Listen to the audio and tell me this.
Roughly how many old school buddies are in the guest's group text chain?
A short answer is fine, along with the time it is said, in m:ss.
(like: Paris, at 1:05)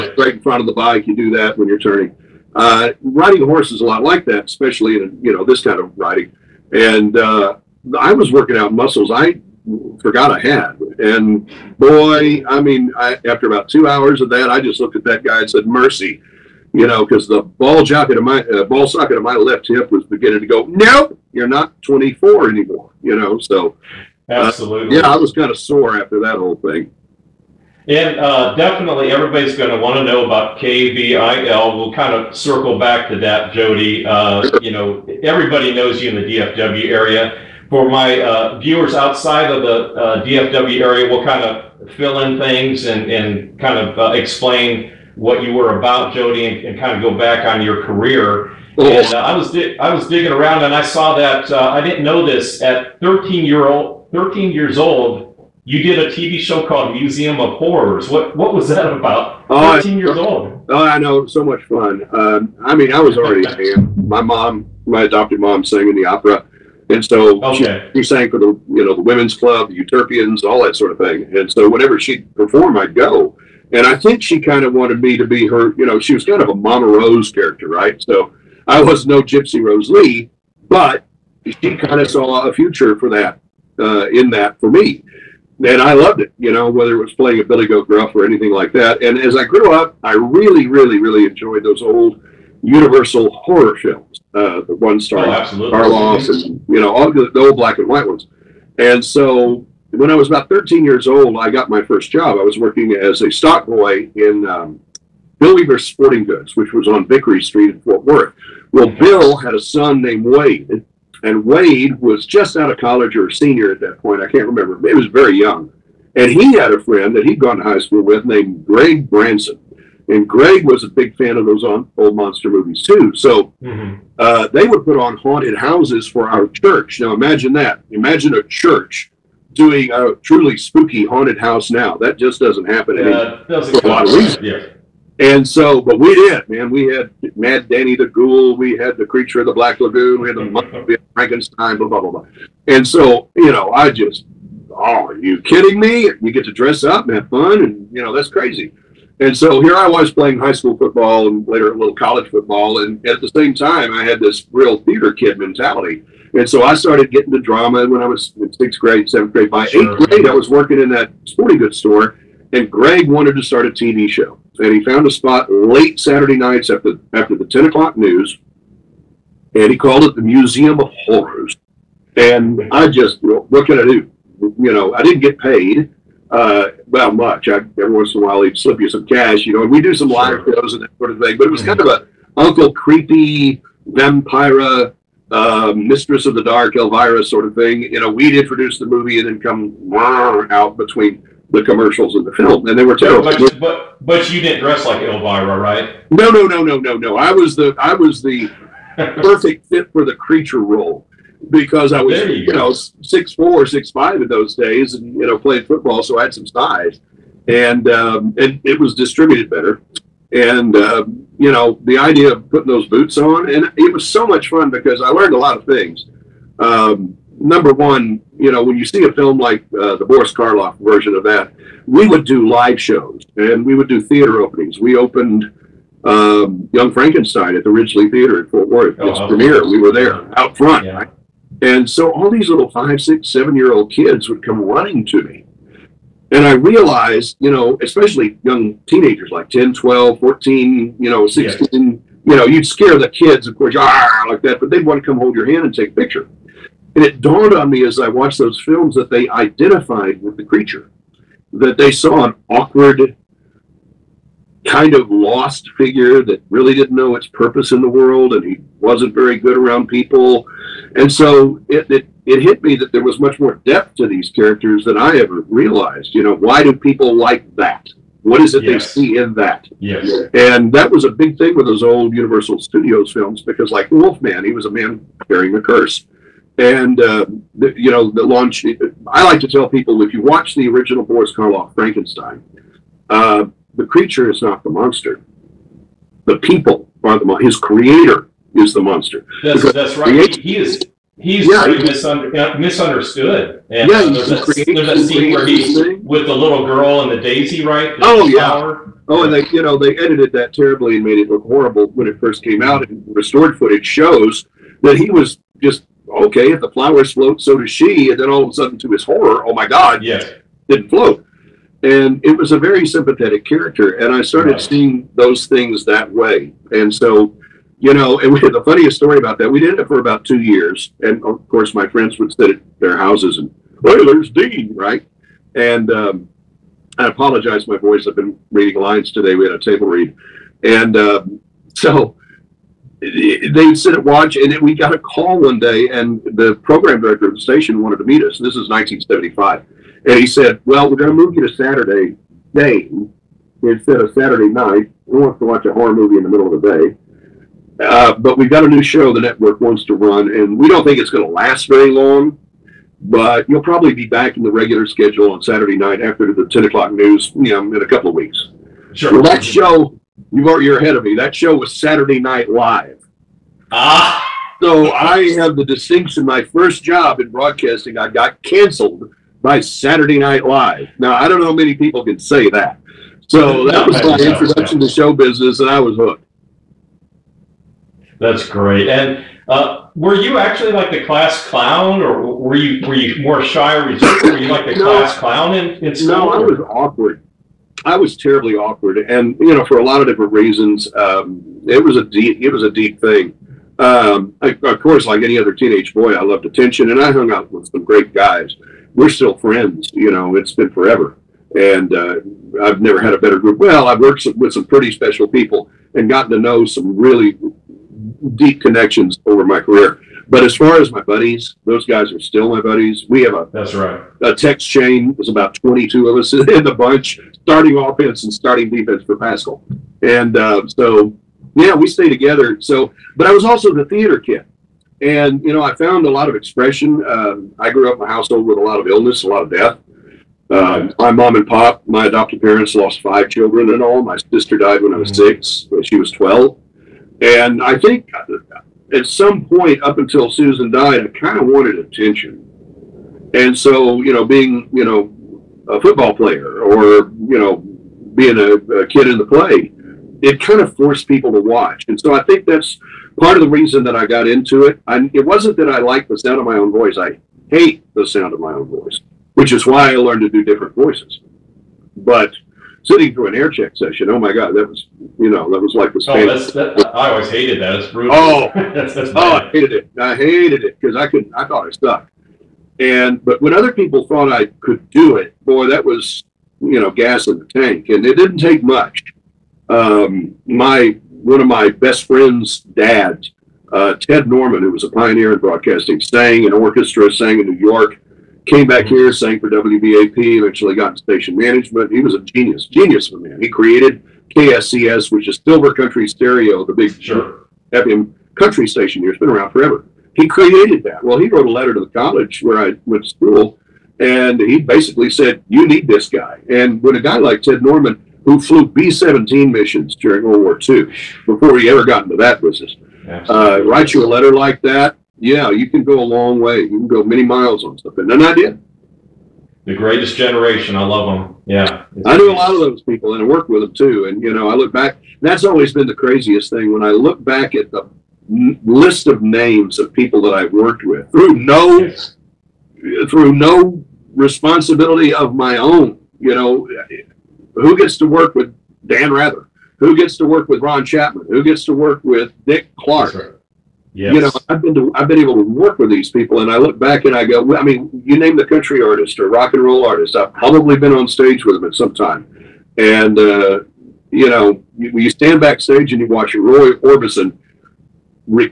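22, at 6:55.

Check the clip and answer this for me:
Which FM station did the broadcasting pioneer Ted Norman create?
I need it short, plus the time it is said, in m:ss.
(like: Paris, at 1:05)
KSCS, at 8:14.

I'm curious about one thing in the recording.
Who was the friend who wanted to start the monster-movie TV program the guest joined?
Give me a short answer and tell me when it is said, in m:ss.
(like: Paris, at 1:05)
Greg Branson, at 1:58.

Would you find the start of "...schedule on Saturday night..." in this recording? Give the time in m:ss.
5:54.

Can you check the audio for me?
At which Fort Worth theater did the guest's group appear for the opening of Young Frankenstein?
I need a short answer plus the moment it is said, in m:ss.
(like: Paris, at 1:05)
Ridglea Theater, at 3:47.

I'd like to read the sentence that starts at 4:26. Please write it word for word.
You know, why do people like that?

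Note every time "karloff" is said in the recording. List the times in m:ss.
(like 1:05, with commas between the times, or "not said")
3:40, 4:41.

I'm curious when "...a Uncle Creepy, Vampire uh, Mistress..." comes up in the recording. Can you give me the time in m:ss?
3:01.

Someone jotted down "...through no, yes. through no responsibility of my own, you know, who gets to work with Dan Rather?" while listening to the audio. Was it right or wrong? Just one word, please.
right.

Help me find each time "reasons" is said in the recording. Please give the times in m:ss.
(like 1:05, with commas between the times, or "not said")
6:30, 7:33.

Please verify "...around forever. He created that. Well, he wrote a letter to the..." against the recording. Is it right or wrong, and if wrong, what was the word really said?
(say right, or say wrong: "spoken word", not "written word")
right.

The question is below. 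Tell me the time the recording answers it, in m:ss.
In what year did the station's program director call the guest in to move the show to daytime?
5:38.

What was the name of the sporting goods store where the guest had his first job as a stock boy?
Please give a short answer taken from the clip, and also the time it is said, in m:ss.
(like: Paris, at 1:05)
Bill Weaver's Sporting Goods, at 1:45.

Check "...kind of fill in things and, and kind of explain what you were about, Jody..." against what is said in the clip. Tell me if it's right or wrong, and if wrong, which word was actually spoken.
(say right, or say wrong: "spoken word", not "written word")
right.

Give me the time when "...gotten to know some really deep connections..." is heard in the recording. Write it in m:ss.
6:46.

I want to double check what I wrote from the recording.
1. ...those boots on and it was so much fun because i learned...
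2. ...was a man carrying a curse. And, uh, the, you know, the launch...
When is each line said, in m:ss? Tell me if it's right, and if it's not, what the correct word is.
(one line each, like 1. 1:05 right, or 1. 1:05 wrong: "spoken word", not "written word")
1. 3:32 right
2. 4:34 right.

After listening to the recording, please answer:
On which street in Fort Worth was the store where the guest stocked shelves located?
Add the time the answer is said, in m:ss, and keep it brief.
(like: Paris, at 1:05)
Vickery Street, at 1:47.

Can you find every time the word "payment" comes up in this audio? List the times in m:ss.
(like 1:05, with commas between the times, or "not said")
not said.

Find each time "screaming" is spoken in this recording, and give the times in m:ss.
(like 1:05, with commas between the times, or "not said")
not said.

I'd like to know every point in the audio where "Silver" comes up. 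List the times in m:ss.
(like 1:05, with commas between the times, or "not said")
8:15.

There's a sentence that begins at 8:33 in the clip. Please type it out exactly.
Uh, write you a letter like that, yeah, you can go a long way.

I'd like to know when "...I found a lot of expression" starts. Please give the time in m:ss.
7:05.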